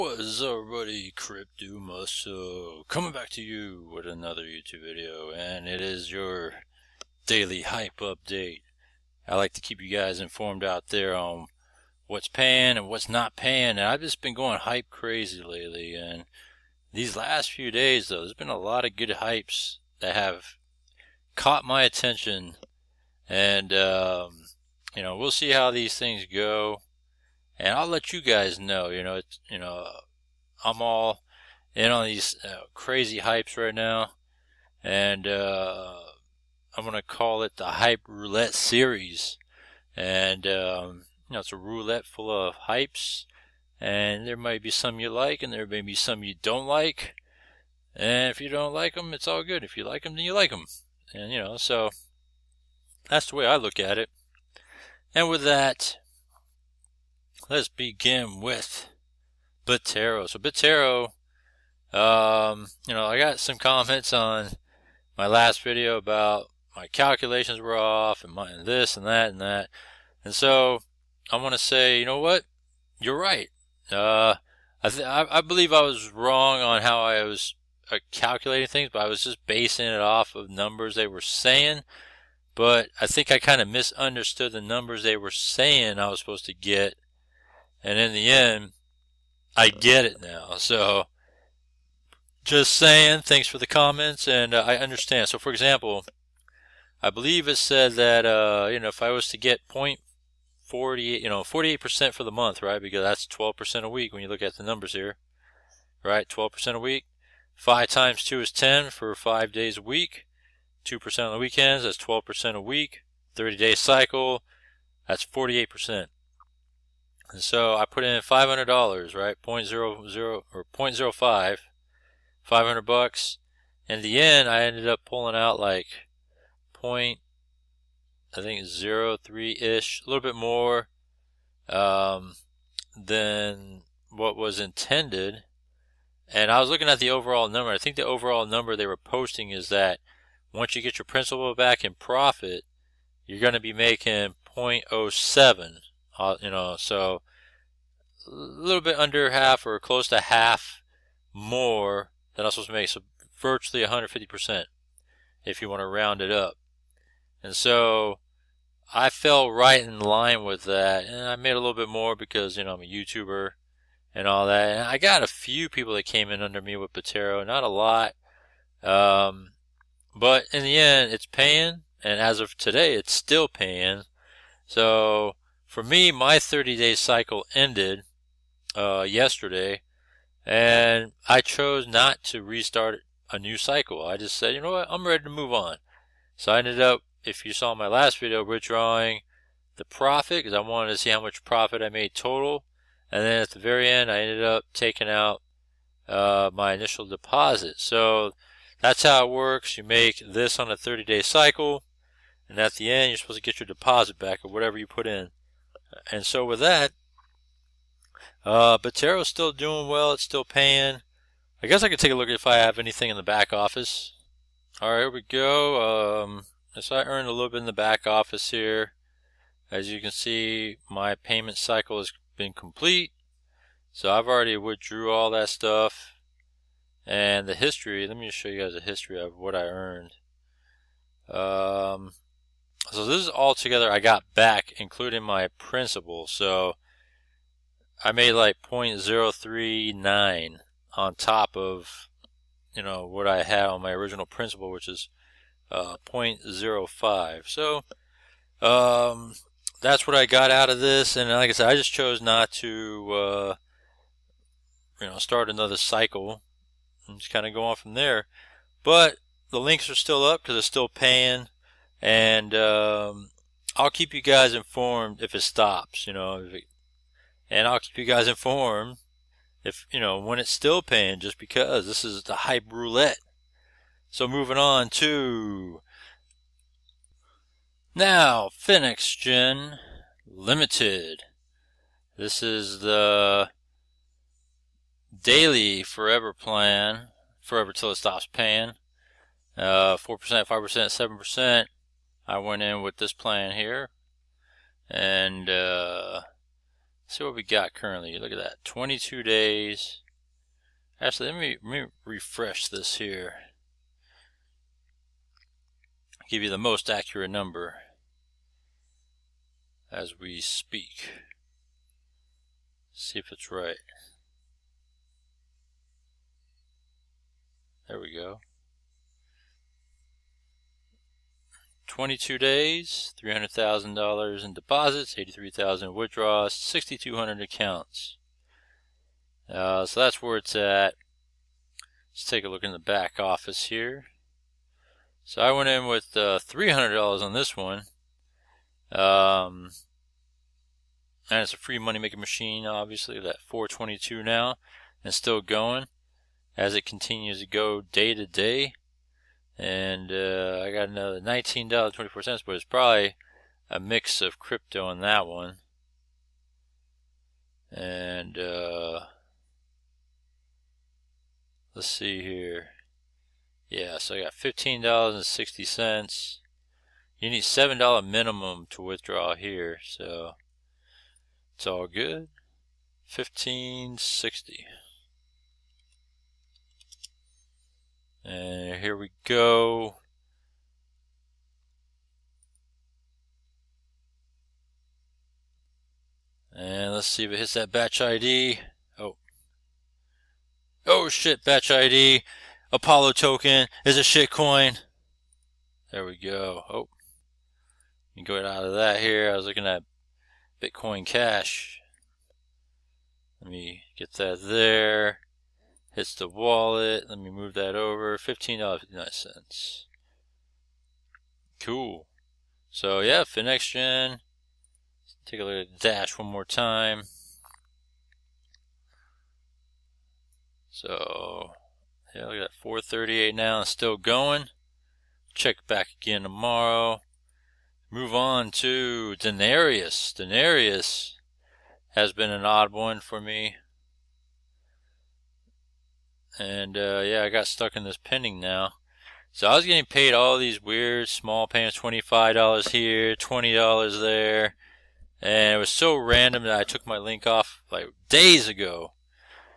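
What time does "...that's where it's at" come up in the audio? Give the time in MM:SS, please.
05:29.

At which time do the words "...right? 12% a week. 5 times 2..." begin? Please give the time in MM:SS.
01:46.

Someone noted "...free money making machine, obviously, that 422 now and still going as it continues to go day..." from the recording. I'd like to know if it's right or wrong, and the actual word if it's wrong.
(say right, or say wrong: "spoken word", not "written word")
right.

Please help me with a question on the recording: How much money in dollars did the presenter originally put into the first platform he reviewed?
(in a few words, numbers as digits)
$500.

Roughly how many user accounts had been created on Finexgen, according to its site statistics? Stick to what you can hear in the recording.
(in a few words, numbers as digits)
6,200.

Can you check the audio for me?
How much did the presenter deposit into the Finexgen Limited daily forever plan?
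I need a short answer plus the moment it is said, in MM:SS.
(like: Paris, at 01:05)
$300, at 05:36.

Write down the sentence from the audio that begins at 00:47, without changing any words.
And if you don't like them, it's all good.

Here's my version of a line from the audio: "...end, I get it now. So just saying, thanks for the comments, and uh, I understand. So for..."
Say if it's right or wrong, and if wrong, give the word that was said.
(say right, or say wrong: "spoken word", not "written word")
right.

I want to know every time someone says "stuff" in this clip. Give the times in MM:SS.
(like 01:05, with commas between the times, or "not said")
03:45.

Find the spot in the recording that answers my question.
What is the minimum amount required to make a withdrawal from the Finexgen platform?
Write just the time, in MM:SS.
06:07.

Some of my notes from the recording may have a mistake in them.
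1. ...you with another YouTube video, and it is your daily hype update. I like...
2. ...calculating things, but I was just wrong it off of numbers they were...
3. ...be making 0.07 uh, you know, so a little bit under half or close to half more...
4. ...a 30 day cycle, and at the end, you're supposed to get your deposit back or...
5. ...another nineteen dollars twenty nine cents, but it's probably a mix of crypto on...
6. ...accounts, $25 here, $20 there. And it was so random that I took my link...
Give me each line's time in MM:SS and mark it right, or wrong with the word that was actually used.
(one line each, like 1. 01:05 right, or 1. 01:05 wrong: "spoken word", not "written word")
1. 00:03 right
2. 01:18 wrong: "basing", not "wrong"
3. 02:23 right
4. 03:20 right
5. 05:50 wrong: "four", not "nine"
6. 07:21 wrong: "payments", not "accounts".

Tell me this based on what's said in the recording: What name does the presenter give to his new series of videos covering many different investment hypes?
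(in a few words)
hype roulette series.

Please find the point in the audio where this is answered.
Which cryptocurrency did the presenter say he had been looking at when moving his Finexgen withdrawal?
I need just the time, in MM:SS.
06:40.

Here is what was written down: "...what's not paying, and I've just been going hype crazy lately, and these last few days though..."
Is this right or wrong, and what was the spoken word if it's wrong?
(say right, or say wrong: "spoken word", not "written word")
right.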